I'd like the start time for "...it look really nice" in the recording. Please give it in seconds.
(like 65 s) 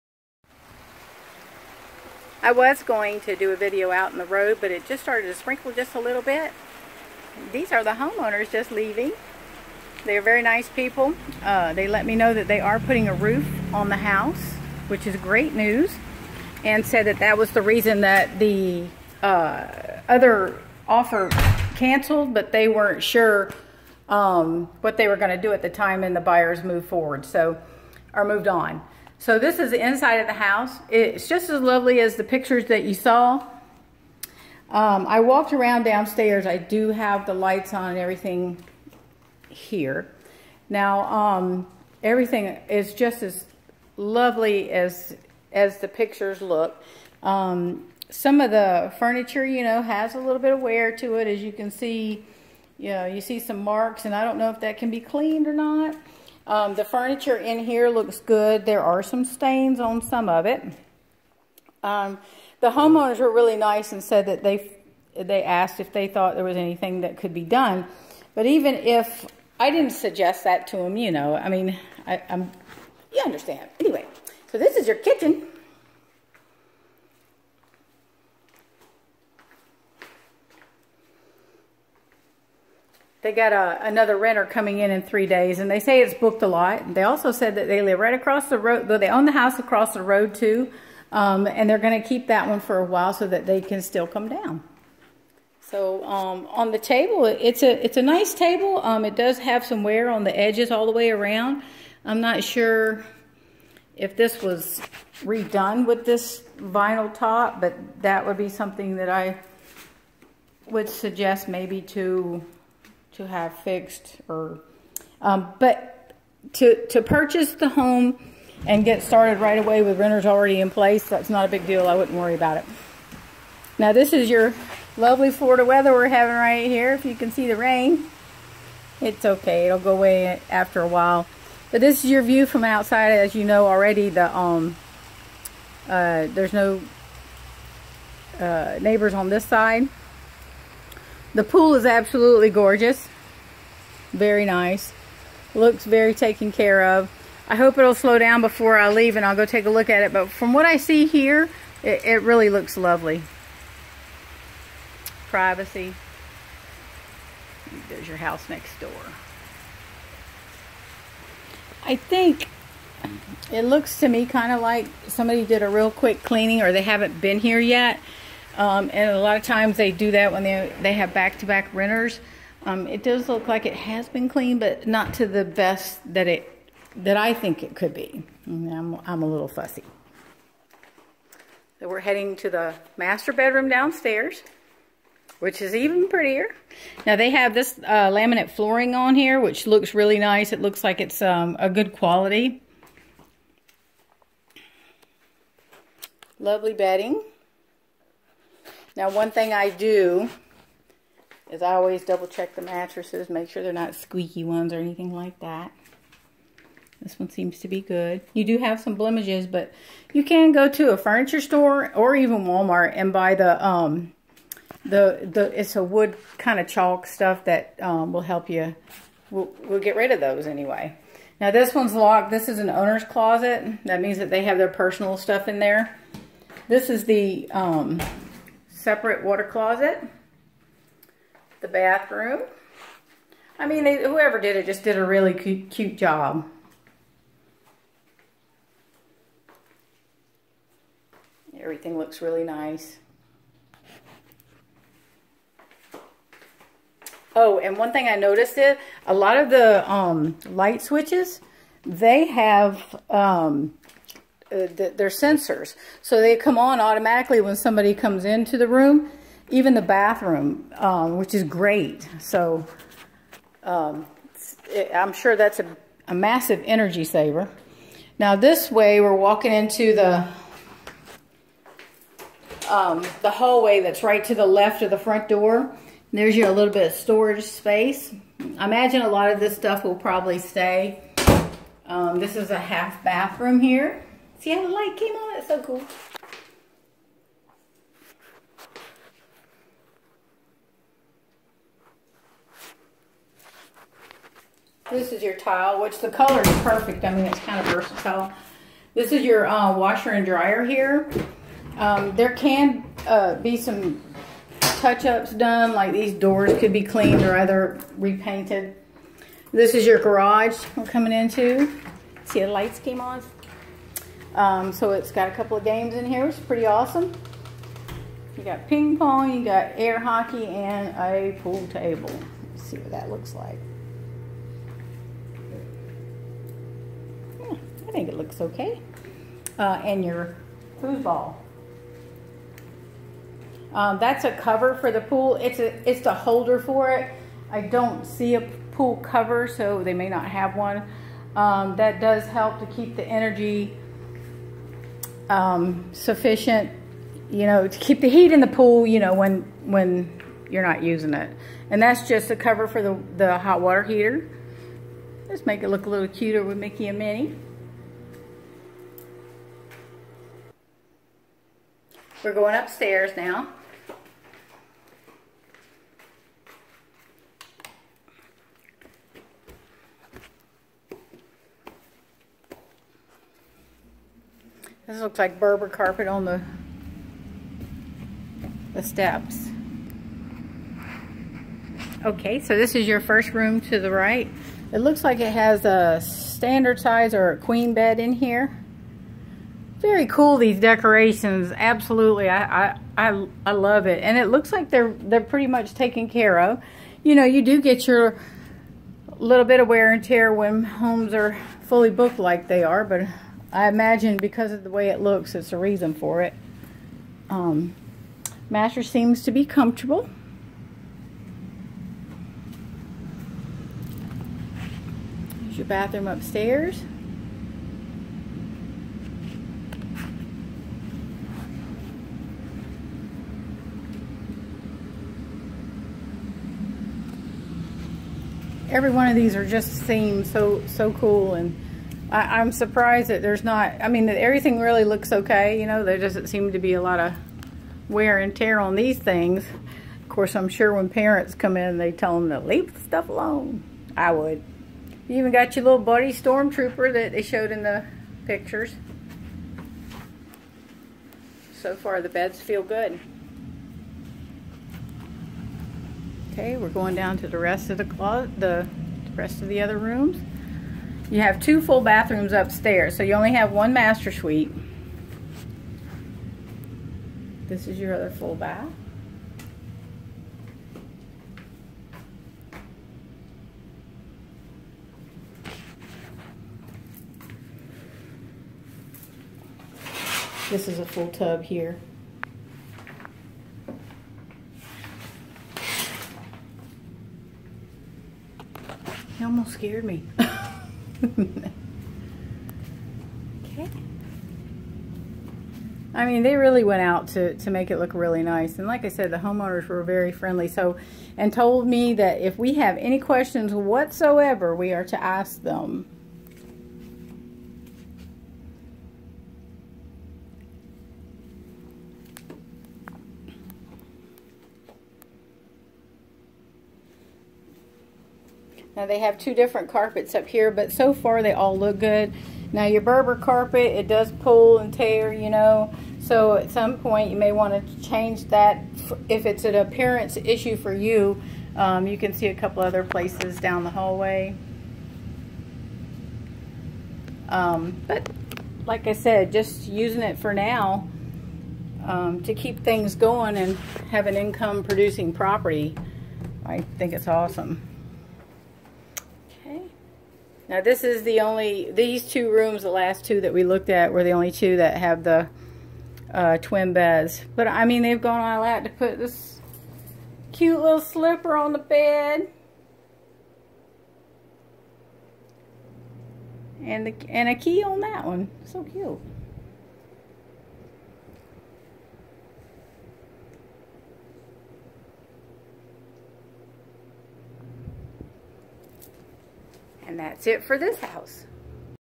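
497 s.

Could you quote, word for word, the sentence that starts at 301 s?
Um, there can uh, be some touch-ups done, like these doors could be cleaned or either repainted.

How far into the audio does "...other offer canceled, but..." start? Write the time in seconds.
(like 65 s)
20 s.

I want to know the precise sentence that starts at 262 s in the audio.
So um, it, I'm sure that's a, a massive energy saver.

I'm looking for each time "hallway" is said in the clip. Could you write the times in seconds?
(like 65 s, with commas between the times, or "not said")
273 s, 533 s.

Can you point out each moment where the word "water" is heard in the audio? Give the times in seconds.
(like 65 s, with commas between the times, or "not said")
229 s, 353 s.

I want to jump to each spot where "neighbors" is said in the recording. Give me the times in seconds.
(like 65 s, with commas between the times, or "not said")
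138 s.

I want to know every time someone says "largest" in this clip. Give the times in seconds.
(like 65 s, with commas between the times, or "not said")
not said.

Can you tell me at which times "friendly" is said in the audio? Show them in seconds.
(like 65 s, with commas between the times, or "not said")
500 s.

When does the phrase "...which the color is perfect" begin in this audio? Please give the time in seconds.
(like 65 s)
295 s.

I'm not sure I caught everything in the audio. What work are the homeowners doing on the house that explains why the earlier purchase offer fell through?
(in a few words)
Putting a roof on.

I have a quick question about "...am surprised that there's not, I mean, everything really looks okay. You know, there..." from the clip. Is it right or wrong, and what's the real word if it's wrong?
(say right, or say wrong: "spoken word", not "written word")
right.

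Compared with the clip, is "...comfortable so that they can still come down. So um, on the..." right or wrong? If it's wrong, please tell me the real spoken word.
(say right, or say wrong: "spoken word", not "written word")
wrong: "while", not "comfortable".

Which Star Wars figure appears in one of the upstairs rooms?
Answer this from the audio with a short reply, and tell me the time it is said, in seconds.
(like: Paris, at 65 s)
Stormtrooper, at 446 s.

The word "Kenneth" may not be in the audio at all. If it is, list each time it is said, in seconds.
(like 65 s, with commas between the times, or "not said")
not said.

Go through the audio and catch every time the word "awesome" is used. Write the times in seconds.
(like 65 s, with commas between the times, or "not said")
316 s, 547 s.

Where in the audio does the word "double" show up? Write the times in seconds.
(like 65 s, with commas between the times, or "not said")
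202 s.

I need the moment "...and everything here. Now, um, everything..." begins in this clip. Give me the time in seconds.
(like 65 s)
37 s.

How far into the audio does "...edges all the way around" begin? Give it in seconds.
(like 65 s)
100 s.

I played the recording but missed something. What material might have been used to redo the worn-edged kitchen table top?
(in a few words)
Vinyl.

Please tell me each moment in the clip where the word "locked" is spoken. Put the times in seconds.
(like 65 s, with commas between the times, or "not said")
221 s.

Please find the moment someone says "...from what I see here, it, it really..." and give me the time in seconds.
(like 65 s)
150 s.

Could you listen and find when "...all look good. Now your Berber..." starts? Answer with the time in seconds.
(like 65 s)
521 s.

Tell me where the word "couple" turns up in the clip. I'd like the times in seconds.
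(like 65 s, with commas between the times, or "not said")
315 s, 532 s.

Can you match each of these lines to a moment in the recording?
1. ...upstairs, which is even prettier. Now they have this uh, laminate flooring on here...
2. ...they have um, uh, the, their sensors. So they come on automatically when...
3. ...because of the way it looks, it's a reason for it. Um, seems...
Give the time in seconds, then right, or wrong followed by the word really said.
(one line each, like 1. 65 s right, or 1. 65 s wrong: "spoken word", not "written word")
1. 183 s wrong: "downstairs", not "upstairs"
2. 251 s right
3. 404 s right.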